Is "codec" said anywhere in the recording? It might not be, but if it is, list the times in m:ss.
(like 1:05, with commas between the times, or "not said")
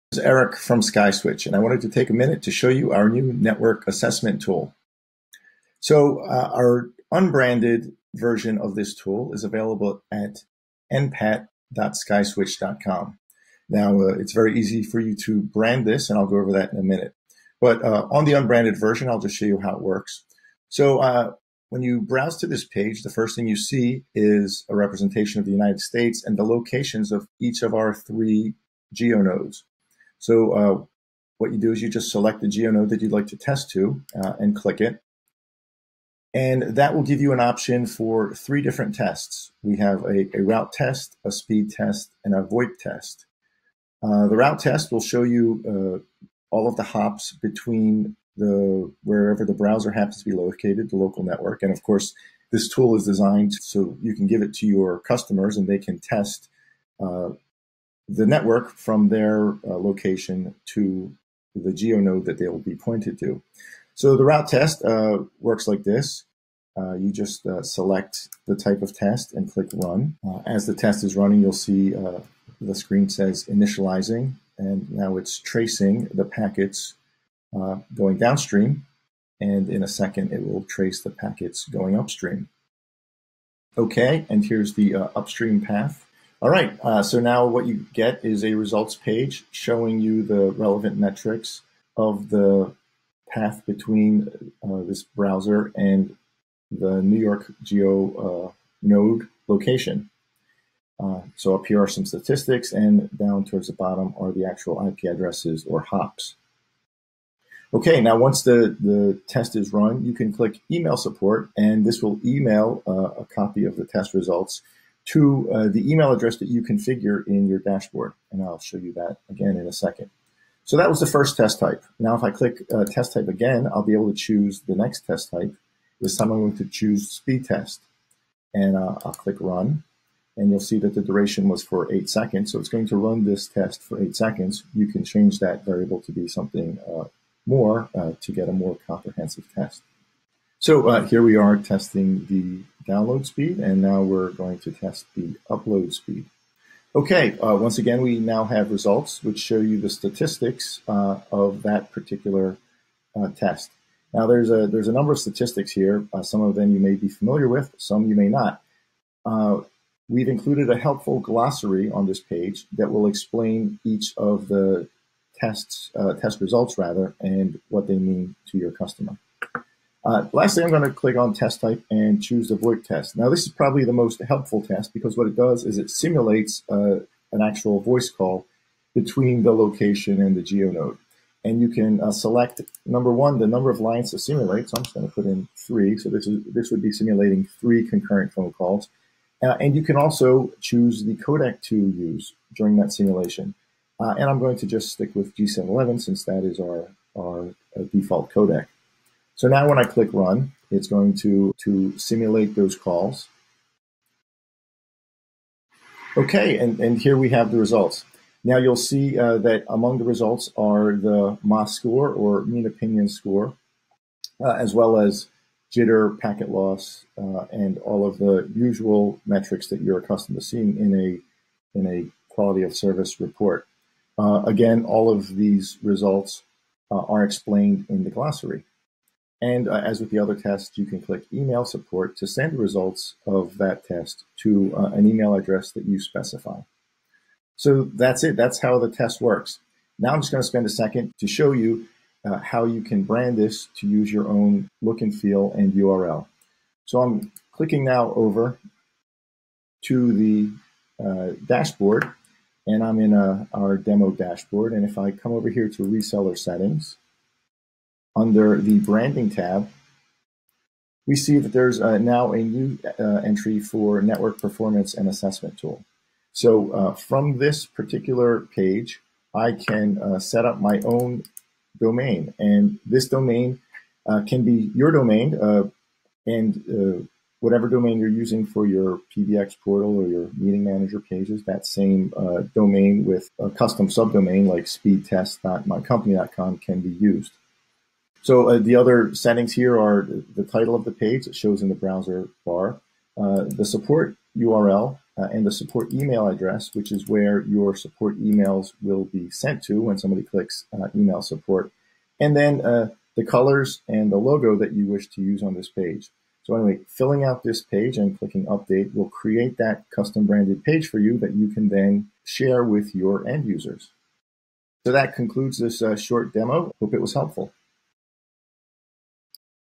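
3:11, 3:18.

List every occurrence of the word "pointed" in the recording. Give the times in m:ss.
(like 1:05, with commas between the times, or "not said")
1:02.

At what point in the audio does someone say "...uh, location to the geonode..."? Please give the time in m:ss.
0:59.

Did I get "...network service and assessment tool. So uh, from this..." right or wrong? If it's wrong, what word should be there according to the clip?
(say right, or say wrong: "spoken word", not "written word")
wrong: "performance", not "service".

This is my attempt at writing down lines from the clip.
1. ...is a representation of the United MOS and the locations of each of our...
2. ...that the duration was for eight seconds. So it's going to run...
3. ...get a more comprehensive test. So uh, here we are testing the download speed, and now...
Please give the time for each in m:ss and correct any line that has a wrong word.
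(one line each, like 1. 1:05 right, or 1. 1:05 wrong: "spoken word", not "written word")
1. 0:24 wrong: "States", not "MOS"
2. 2:10 right
3. 2:18 right.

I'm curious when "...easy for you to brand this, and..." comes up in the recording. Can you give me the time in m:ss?
0:14.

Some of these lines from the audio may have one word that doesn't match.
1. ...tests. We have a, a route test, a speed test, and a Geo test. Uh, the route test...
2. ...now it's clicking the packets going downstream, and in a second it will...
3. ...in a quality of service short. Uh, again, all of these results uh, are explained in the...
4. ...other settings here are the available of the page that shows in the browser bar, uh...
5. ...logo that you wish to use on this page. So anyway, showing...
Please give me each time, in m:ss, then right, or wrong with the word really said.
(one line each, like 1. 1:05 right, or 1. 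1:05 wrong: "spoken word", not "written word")
1. 0:38 wrong: "VoIP", not "Geo"
2. 1:14 wrong: "tracing", not "clicking"
3. 3:41 wrong: "report", not "short"
4. 4:48 wrong: "title", not "available"
5. 5:04 wrong: "filling", not "showing".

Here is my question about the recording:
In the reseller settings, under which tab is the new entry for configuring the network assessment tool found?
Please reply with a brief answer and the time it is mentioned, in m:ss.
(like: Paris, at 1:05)
Branding, at 4:18.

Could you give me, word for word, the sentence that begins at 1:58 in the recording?
And I'll show you that again in a second.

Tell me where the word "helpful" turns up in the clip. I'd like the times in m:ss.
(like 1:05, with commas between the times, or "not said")
2:40, 2:54, 5:17.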